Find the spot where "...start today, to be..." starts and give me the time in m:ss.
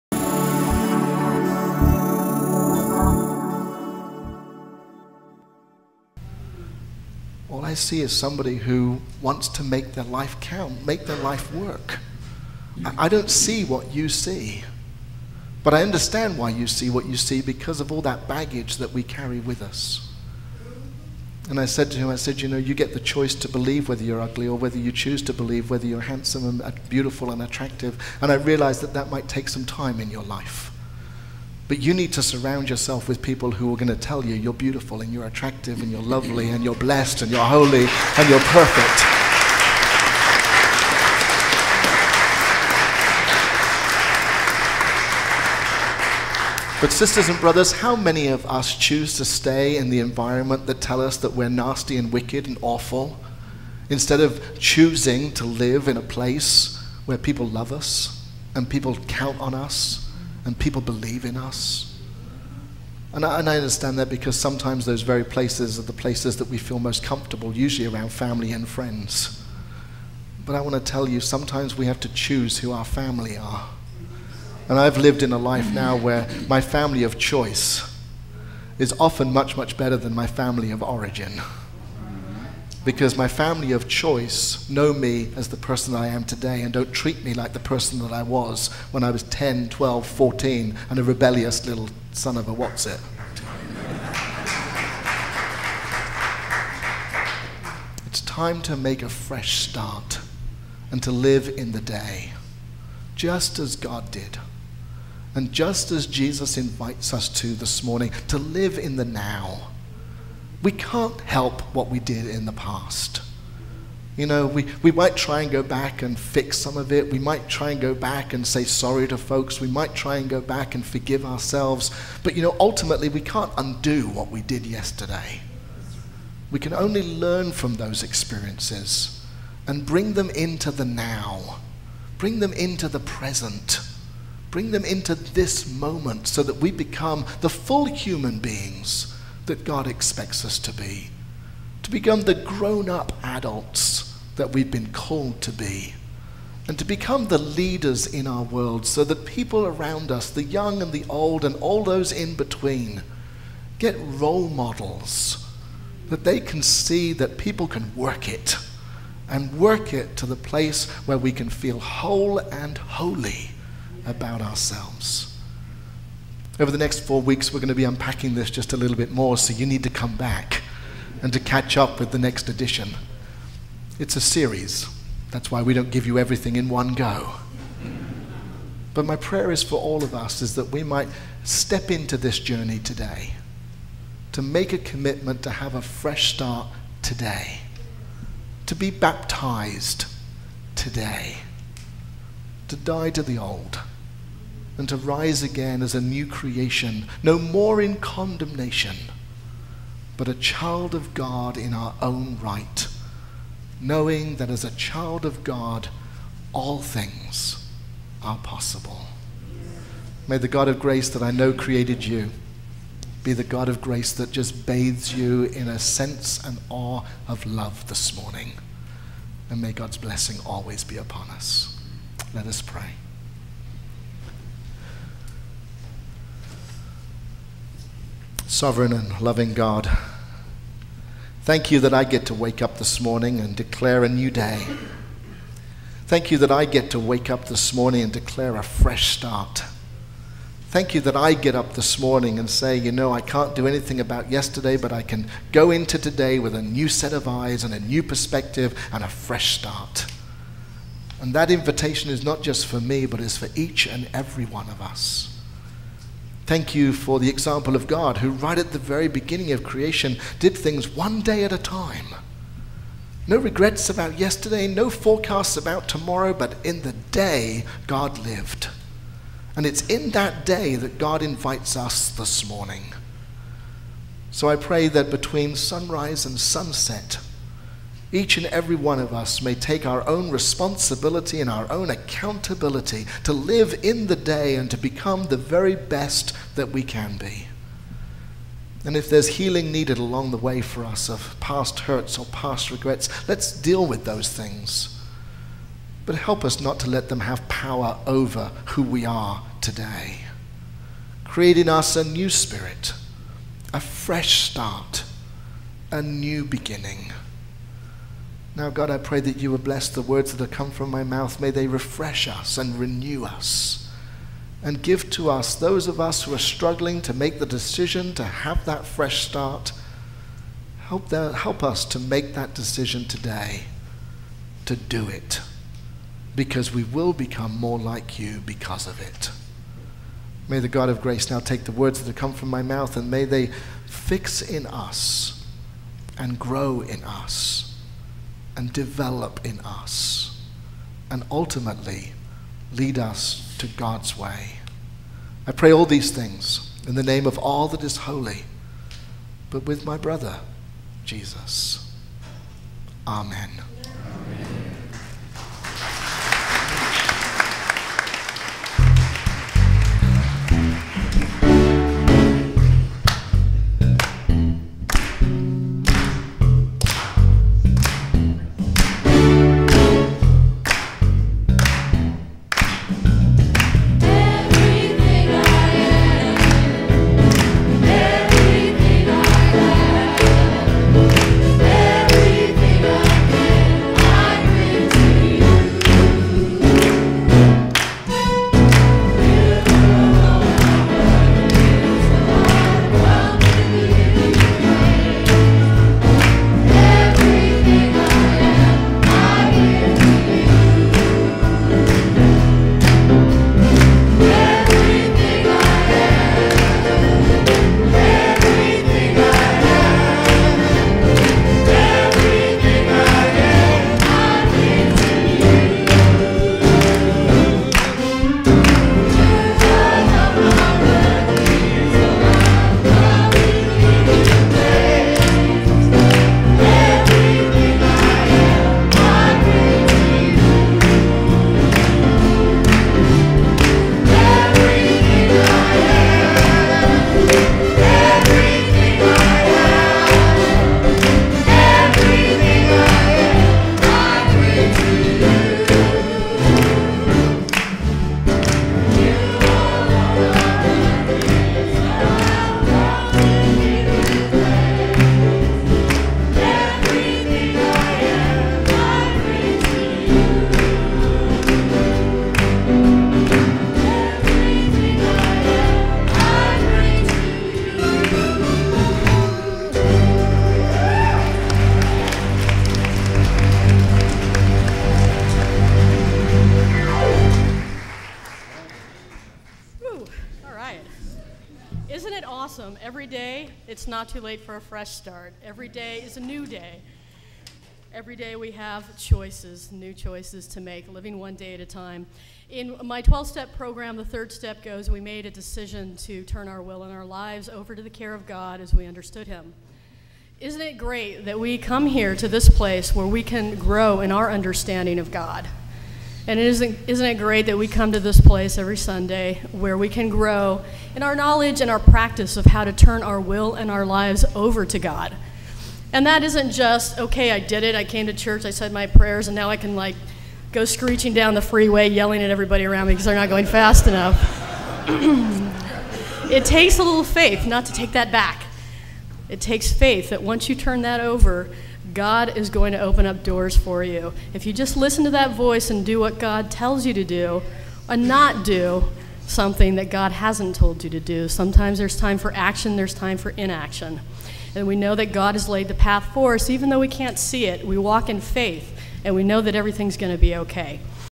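3:06.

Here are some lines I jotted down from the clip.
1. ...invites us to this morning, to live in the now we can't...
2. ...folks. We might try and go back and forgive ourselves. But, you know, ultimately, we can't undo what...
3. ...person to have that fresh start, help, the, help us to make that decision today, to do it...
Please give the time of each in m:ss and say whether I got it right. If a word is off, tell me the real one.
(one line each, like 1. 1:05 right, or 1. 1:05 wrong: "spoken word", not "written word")
1. 1:46 right
2. 1:59 right
3. 5:17 wrong: "decision", not "person".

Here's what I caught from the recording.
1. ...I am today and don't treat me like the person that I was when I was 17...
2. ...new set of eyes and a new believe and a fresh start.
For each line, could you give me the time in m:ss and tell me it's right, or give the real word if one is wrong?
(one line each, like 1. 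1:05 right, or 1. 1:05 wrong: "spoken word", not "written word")
1. 1:25 wrong: "10", not "17"
2. 4:06 wrong: "perspective", not "believe".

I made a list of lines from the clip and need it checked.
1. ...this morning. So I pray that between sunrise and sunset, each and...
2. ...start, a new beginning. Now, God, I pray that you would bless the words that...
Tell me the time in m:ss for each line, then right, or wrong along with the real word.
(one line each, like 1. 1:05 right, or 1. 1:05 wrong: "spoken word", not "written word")
1. 4:32 right
2. 5:04 right.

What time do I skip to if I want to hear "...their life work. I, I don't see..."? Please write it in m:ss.
0:11.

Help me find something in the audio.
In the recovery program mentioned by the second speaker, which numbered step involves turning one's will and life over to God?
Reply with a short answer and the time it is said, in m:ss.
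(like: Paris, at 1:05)
third step, at 8:13.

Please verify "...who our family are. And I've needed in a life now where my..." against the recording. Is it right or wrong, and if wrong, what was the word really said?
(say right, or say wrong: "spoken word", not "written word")
wrong: "lived", not "needed".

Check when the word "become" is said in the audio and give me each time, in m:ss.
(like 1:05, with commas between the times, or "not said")
2:16, 2:21, 2:26, 4:44, 5:27.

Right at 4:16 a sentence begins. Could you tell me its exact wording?
Thank you for the example of God, who right at the very beginning of creation did things one day at a time.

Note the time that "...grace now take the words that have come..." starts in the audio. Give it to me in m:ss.
5:31.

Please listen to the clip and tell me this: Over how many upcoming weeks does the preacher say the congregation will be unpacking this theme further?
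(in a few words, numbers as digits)
4.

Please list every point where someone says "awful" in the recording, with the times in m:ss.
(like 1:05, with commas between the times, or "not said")
0:52.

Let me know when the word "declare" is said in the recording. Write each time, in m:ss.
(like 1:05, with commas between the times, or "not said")
3:53, 3:58.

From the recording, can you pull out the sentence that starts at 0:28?
And I realized that that might take some time in your life.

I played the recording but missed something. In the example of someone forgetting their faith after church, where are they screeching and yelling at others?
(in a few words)
down the freeway.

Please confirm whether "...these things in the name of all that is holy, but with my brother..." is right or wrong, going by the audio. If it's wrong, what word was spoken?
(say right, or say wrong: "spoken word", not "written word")
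right.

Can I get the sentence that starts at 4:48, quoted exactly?
And if there's healing needed along the way for us of past hurts or past regrets, let's deal with those things.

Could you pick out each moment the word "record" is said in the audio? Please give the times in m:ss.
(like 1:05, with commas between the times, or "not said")
not said.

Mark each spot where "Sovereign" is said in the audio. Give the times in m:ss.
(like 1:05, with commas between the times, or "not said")
3:48.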